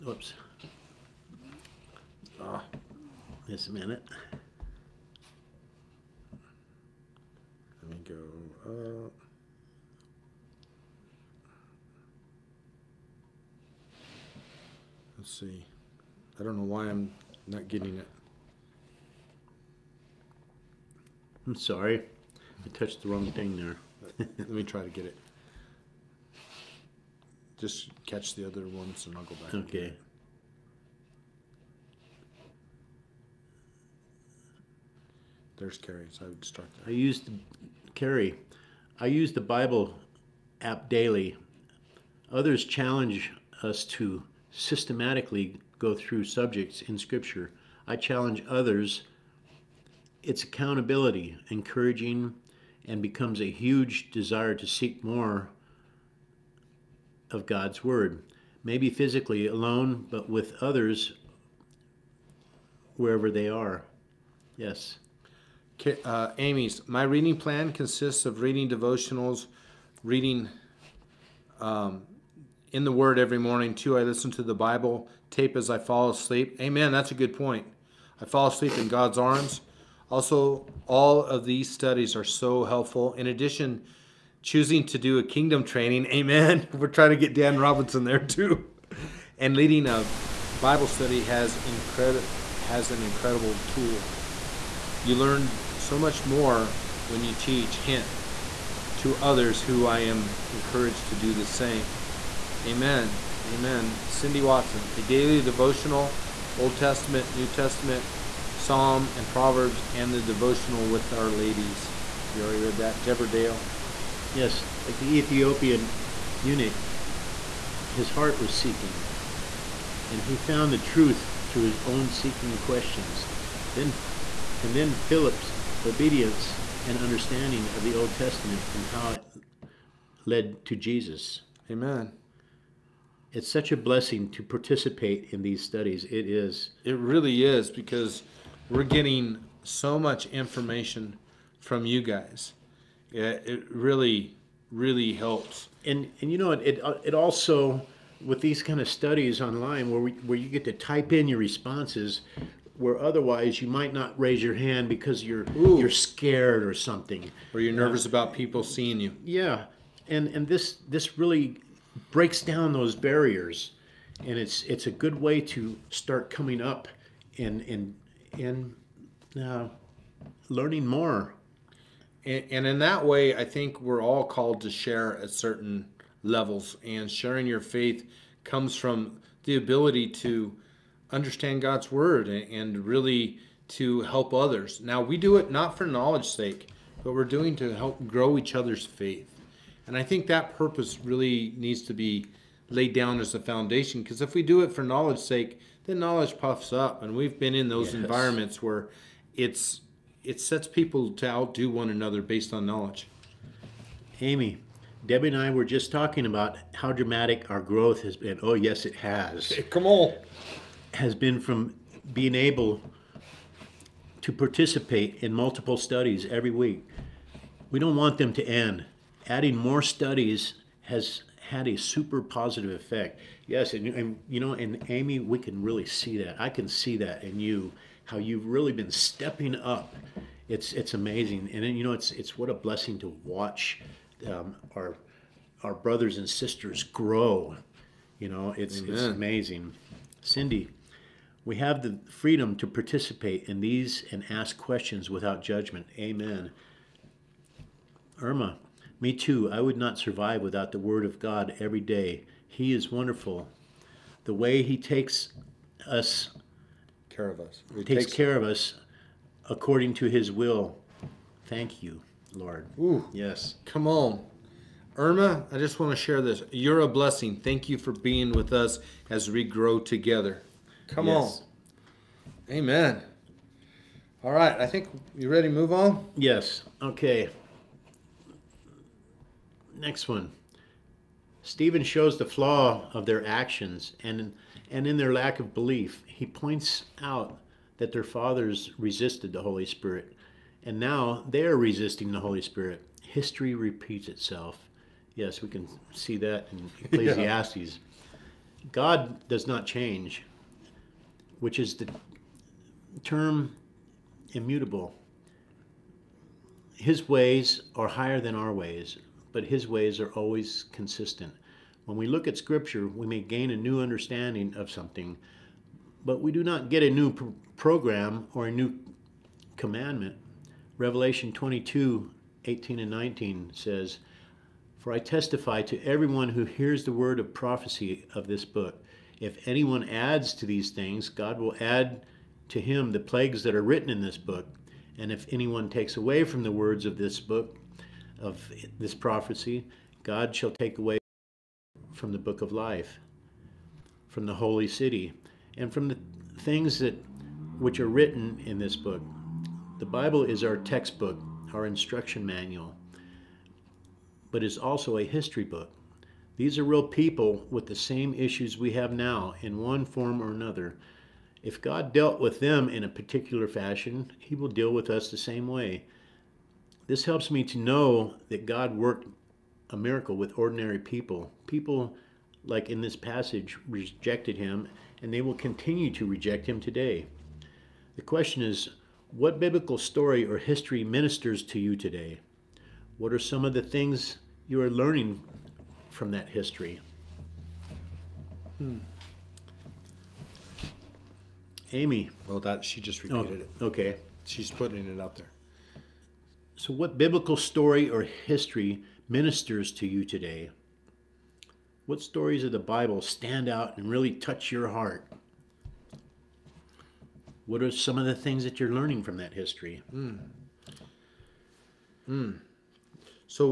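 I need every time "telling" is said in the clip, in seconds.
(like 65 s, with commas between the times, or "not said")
not said.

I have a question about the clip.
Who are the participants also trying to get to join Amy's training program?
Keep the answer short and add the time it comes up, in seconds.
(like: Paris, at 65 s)
Dan Robinson, at 87 s.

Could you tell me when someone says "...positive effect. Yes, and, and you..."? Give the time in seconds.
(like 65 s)
222 s.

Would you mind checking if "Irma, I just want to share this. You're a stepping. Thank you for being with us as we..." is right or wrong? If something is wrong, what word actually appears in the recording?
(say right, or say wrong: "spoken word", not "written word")
wrong: "blessing", not "stepping".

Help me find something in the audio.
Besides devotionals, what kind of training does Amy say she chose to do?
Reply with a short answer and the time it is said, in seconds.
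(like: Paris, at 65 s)
kingdom training, at 85 s.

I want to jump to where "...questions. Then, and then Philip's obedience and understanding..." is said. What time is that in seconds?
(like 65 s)
122 s.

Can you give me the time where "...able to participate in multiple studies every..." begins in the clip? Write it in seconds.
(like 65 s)
212 s.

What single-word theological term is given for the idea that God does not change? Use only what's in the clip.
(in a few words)
immutable.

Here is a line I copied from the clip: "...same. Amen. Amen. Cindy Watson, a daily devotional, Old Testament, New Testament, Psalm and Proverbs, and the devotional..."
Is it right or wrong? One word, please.
right.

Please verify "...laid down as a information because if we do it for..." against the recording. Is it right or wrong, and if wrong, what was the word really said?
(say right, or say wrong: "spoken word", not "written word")
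wrong: "foundation", not "information".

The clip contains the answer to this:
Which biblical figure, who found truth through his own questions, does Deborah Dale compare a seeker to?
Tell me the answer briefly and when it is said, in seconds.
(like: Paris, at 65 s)
the Ethiopian eunuch, at 115 s.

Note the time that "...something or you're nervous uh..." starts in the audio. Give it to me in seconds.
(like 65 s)
156 s.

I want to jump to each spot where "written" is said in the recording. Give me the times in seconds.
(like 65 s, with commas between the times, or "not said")
333 s, 347 s.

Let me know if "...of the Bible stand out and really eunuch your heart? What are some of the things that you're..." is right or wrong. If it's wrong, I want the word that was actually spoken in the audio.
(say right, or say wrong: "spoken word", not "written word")
wrong: "touch", not "eunuch".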